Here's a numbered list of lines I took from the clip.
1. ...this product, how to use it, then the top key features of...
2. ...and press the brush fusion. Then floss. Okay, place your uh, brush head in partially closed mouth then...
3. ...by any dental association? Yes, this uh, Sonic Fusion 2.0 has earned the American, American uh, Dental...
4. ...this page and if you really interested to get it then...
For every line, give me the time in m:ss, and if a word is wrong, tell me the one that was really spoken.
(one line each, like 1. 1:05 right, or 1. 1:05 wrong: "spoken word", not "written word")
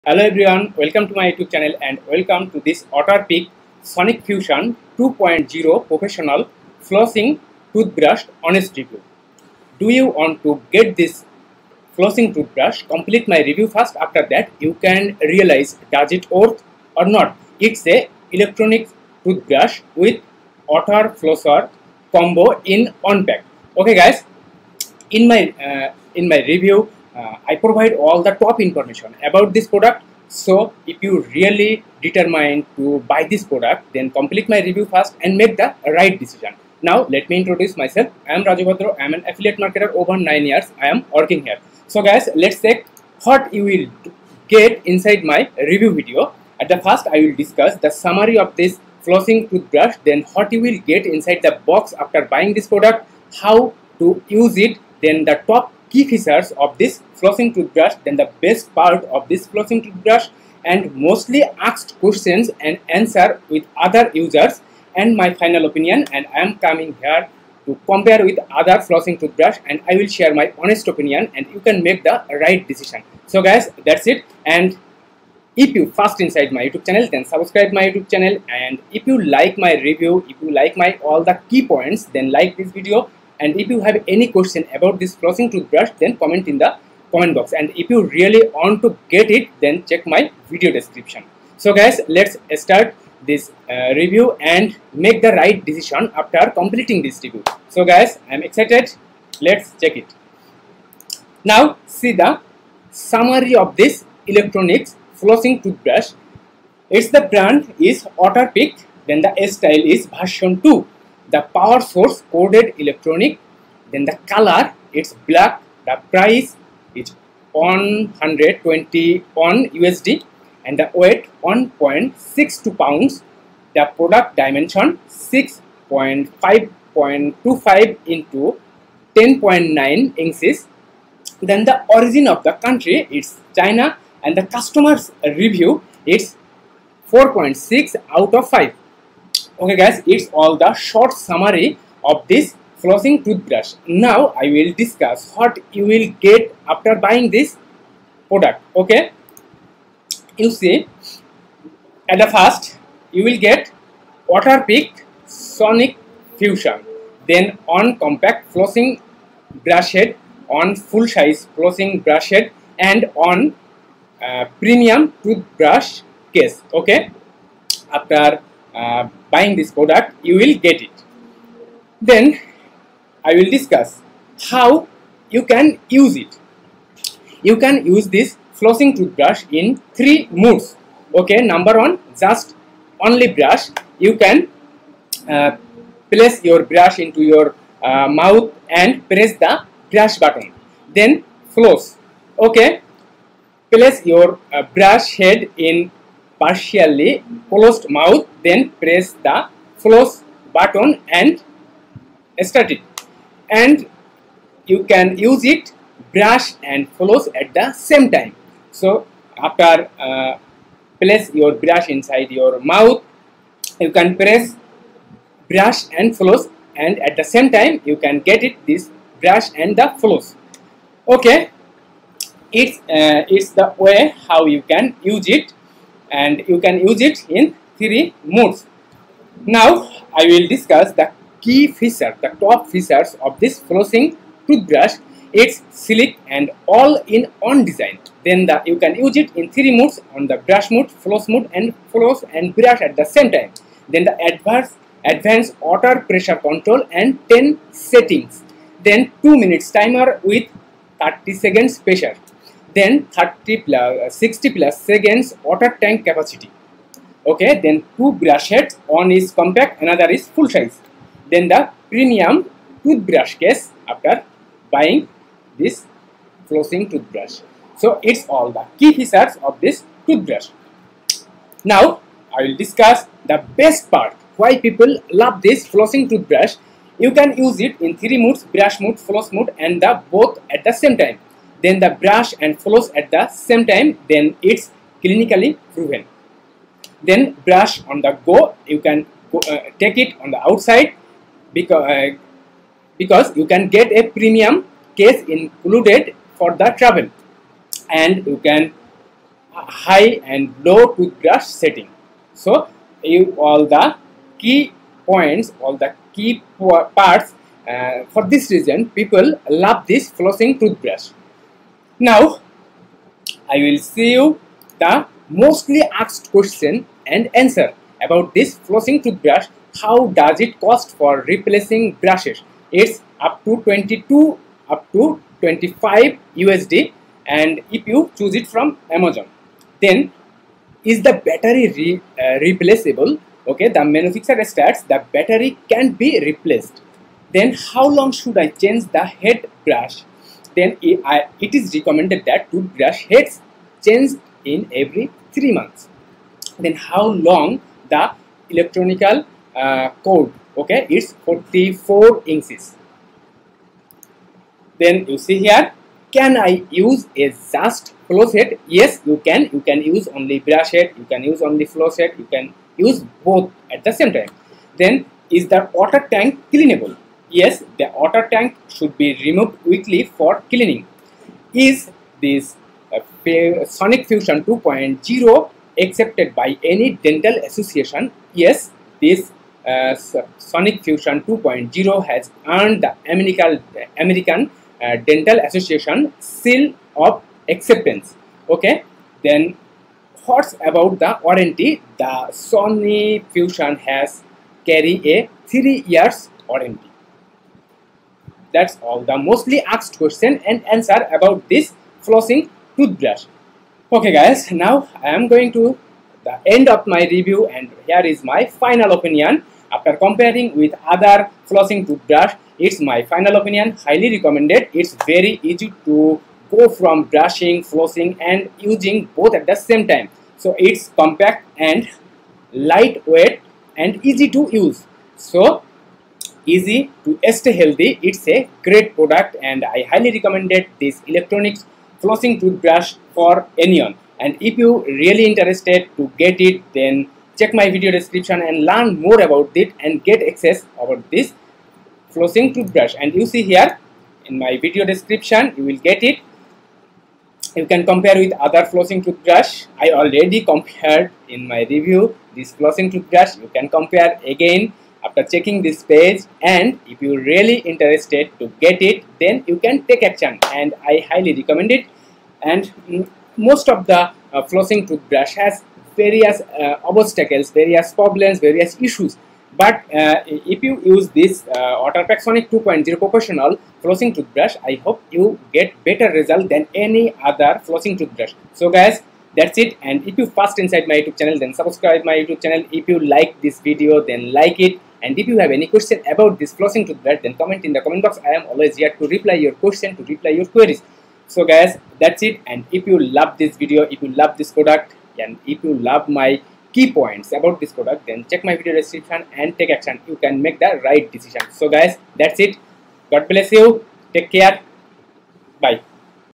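1. 0:52 right
2. 3:08 wrong: "button", not "fusion"
3. 6:16 right
4. 7:35 right.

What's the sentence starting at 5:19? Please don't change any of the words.
How does it cost for replacing brushes?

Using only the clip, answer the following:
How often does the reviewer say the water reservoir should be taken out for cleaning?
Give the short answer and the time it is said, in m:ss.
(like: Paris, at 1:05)
weekly, at 6:09.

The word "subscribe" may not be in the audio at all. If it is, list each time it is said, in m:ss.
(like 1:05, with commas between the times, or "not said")
1:17, 8:01.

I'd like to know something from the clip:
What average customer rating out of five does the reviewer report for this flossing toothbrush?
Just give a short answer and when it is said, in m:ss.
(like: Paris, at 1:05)
4.6, at 2:17.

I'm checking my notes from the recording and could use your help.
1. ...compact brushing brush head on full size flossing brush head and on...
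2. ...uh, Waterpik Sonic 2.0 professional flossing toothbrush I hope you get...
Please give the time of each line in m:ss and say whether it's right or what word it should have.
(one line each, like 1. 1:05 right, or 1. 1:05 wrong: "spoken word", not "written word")
1. 2:37 wrong: "flossing", not "brushing"
2. 7:51 right.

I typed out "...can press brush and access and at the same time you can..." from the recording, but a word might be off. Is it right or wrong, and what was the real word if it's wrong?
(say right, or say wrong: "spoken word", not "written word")
wrong: "floss", not "access".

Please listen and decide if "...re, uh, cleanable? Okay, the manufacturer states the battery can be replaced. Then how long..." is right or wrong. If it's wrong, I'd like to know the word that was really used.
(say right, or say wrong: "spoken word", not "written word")
wrong: "replaceable", not "cleanable".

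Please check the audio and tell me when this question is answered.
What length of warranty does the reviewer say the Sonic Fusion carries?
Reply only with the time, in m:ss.
6:35.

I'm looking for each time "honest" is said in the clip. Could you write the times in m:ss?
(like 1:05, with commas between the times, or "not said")
0:08, 1:10.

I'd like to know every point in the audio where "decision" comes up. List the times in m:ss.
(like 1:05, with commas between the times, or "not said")
0:36, 1:12, 1:35, 8:21.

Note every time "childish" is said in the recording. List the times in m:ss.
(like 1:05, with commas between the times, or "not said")
not said.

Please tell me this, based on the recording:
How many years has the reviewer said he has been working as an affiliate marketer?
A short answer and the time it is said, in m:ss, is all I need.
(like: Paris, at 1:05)
9, at 0:40.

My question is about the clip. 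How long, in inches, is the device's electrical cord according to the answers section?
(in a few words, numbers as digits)
44 inches.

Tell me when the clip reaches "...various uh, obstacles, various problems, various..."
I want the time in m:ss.
7:45.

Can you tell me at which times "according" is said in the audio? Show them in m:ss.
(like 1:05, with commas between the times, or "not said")
not said.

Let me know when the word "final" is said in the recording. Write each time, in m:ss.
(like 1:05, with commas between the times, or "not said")
1:05, 6:48, 6:53.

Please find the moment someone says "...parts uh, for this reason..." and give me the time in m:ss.
5:06.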